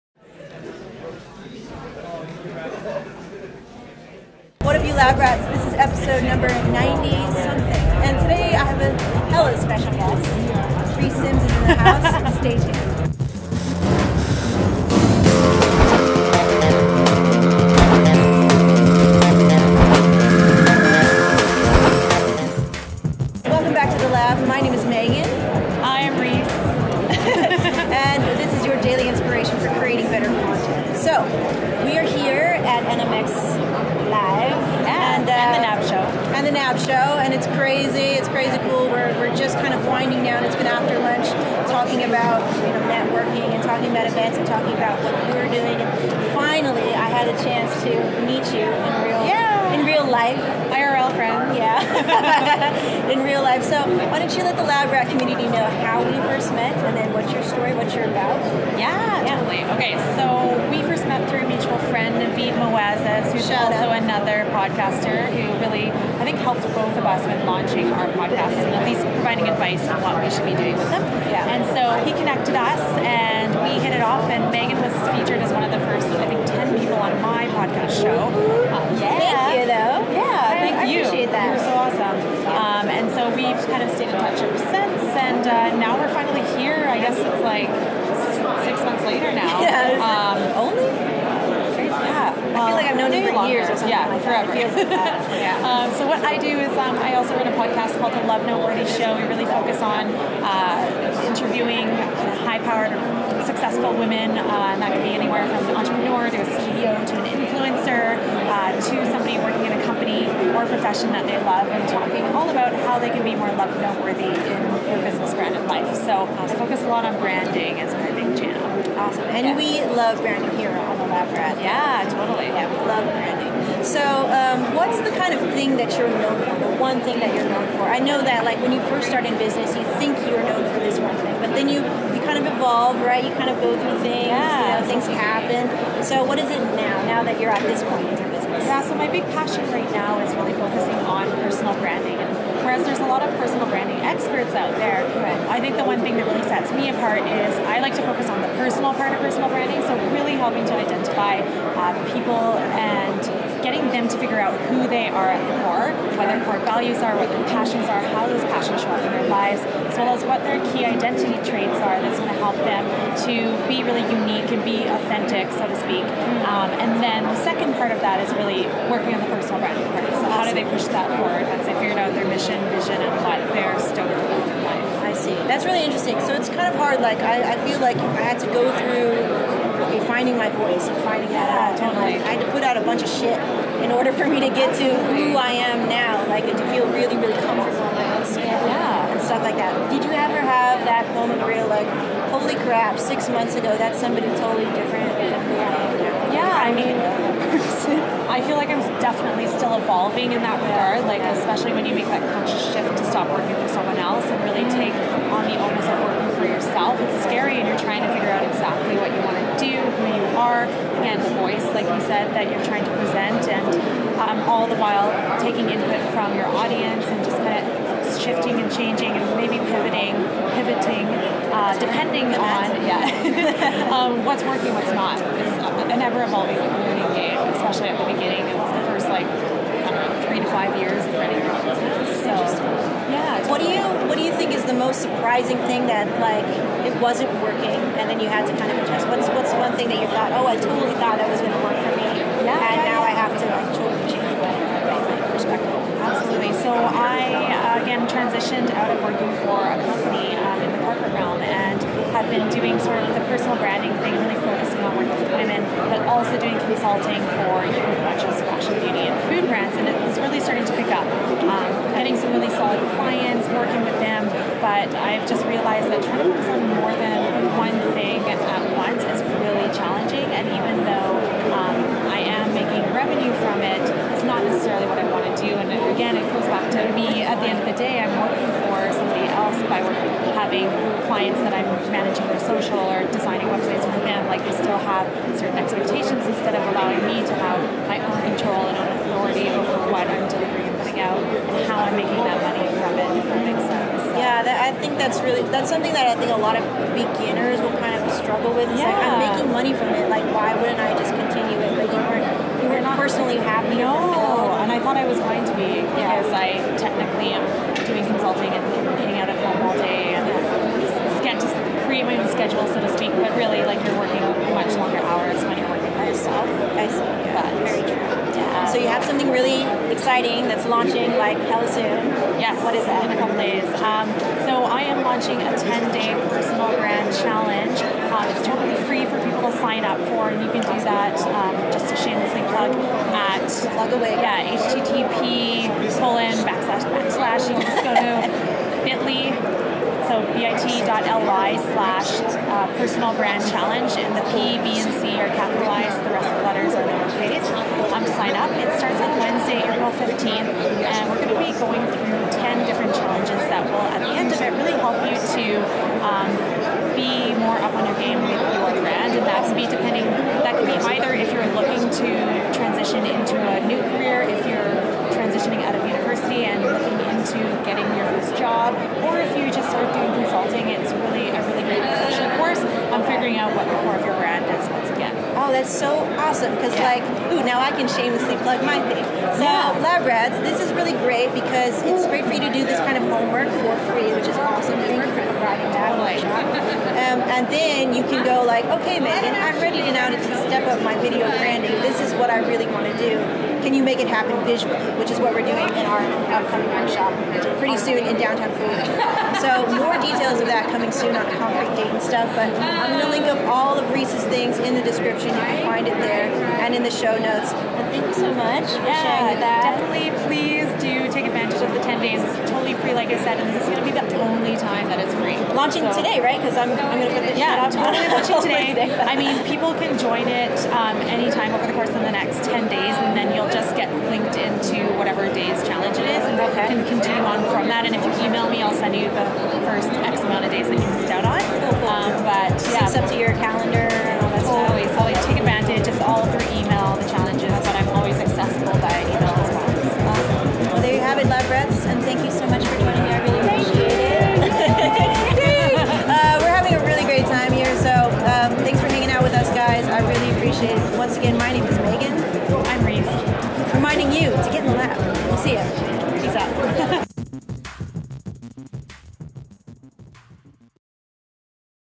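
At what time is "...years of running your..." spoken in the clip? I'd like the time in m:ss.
3:50.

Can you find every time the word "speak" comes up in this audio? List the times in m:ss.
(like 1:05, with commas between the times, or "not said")
2:45, 5:12.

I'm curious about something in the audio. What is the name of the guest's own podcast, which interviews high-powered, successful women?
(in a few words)
The Lovenoteworthy Show.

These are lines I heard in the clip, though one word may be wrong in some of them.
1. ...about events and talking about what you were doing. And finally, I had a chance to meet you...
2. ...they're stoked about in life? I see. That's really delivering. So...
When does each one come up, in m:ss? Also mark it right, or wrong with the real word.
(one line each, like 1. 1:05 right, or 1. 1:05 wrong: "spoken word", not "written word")
1. 0:43 right
2. 2:53 wrong: "interesting", not "delivering".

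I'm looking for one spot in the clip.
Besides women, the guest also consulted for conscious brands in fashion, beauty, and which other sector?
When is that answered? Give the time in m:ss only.
4:19.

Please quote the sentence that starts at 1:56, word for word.
So uh, I focus a lot on branding as my big channel.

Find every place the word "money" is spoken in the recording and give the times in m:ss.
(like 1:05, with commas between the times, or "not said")
4:52, 4:59.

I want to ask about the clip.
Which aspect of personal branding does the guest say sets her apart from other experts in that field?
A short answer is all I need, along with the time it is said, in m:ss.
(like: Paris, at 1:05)
the personal part, at 2:28.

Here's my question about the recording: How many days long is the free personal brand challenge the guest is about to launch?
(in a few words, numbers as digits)
10.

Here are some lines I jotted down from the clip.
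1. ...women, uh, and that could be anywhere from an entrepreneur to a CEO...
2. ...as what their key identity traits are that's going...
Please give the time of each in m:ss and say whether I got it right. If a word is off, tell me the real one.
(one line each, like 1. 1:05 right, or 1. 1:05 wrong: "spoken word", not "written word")
1. 1:43 right
2. 2:40 right.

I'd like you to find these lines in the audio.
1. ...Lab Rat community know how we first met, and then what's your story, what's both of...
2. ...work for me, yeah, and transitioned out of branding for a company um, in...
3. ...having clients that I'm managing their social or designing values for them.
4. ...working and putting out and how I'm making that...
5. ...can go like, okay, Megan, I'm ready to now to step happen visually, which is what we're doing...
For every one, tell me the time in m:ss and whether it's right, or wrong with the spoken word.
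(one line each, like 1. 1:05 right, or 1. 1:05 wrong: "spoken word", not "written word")
1. 0:54 right
2. 4:01 wrong: "working", not "branding"
3. 4:40 wrong: "websites", not "values"
4. 4:50 wrong: "delivering", not "working"
5. 6:28 right.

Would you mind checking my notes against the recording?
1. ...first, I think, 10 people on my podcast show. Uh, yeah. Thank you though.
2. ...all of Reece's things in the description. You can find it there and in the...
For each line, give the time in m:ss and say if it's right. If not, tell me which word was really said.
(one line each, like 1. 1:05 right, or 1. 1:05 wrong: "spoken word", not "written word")
1. 1:15 right
2. 6:43 right.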